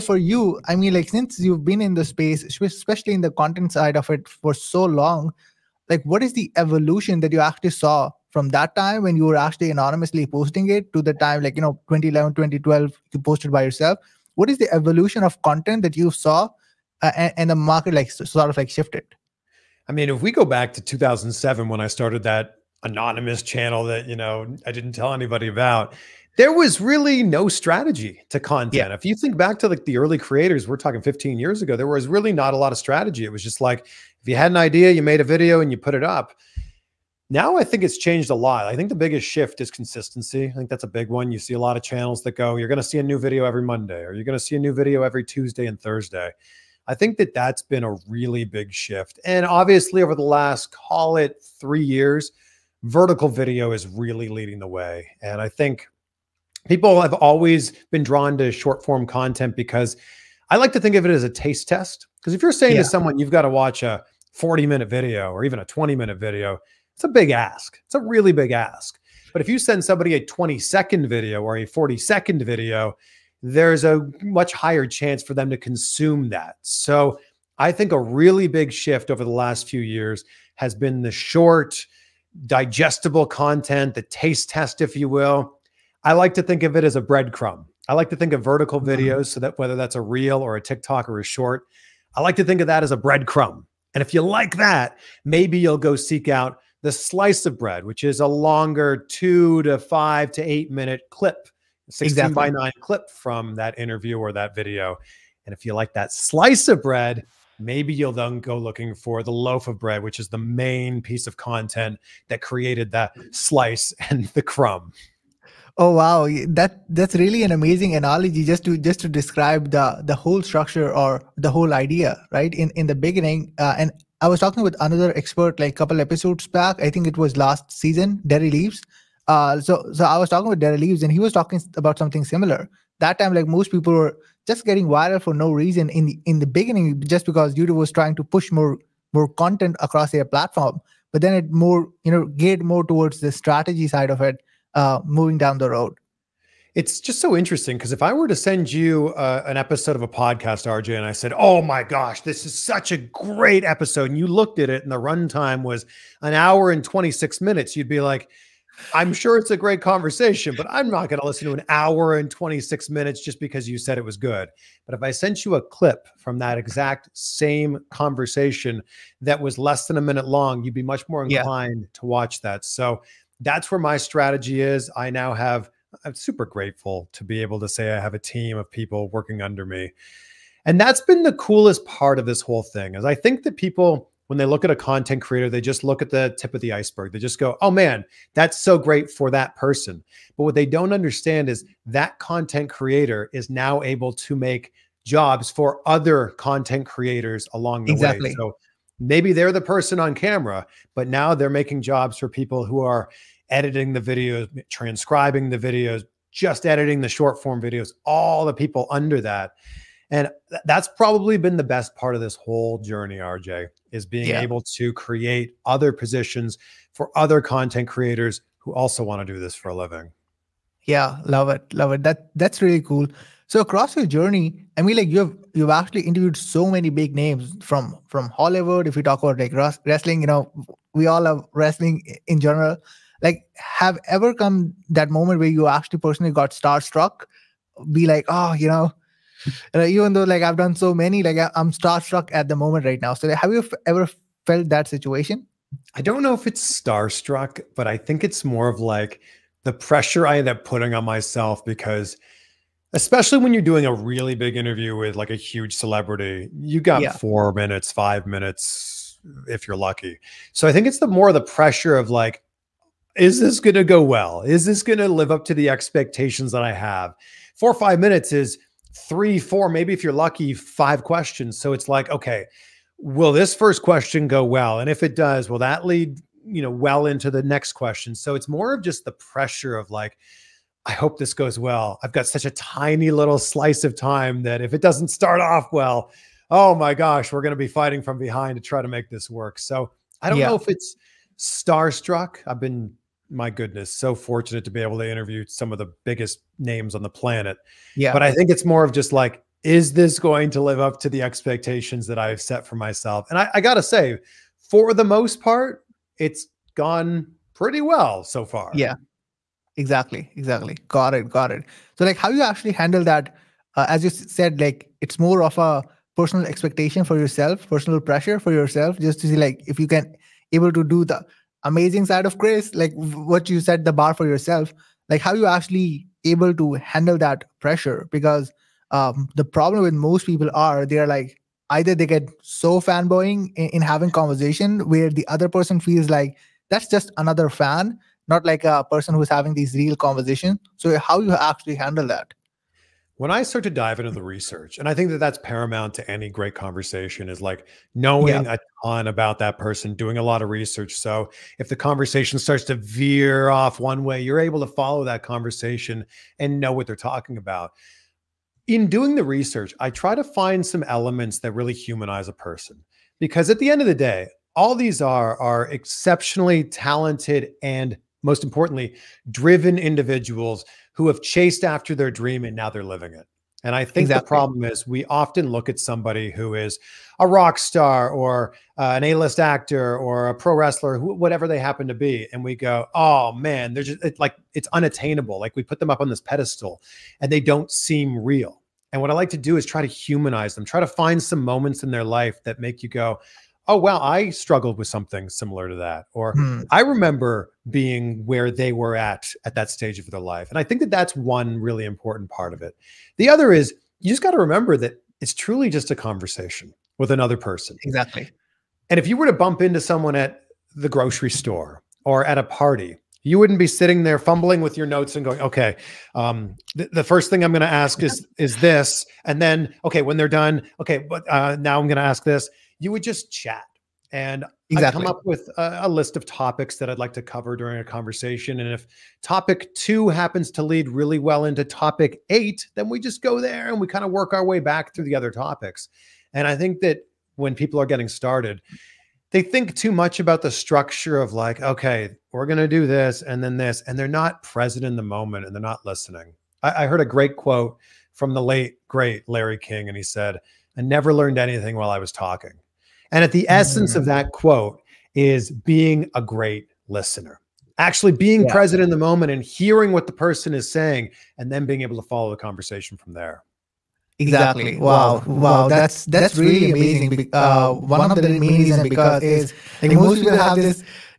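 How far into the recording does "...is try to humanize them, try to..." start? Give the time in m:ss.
6:29.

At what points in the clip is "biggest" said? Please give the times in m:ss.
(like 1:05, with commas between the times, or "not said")
0:38, 4:56.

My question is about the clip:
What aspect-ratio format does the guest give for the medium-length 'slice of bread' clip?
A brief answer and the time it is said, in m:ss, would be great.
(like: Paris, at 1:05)
16 by 9, at 1:41.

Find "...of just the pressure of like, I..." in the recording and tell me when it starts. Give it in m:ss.
4:38.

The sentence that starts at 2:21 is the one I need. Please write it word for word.
But then it more you know geared more towards the strategy side of it, uh, moving down the road.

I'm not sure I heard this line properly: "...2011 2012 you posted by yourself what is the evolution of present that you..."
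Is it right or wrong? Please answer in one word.
wrong.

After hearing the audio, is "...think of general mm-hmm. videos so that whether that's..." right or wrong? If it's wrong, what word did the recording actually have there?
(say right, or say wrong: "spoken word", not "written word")
wrong: "vertical", not "general".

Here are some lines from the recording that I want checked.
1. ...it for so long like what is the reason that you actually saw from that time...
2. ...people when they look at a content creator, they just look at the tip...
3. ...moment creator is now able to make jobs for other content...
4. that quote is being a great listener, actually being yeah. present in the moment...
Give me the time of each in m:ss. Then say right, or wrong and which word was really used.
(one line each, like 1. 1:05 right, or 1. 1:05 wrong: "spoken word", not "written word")
1. 0:04 wrong: "evolution", not "reason"
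2. 3:03 right
3. 3:12 wrong: "content", not "moment"
4. 7:34 right.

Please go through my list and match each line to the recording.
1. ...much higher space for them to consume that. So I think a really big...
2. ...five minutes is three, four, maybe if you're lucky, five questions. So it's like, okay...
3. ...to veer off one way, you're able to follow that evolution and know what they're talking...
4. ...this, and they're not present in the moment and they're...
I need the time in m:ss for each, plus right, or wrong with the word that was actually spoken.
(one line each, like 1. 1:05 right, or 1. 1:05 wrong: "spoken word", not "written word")
1. 1:14 wrong: "chance", not "space"
2. 4:27 right
3. 5:52 wrong: "conversation", not "evolution"
4. 7:23 right.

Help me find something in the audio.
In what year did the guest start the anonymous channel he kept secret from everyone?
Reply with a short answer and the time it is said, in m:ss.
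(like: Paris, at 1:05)
2007, at 0:20.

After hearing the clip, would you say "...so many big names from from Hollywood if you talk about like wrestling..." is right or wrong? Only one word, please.
right.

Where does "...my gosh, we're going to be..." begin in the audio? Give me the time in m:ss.
4:46.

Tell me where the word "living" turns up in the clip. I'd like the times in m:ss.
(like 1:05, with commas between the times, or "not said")
3:39, 6:12.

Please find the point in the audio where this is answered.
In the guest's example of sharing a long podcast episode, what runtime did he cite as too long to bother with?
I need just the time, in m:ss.
2:36.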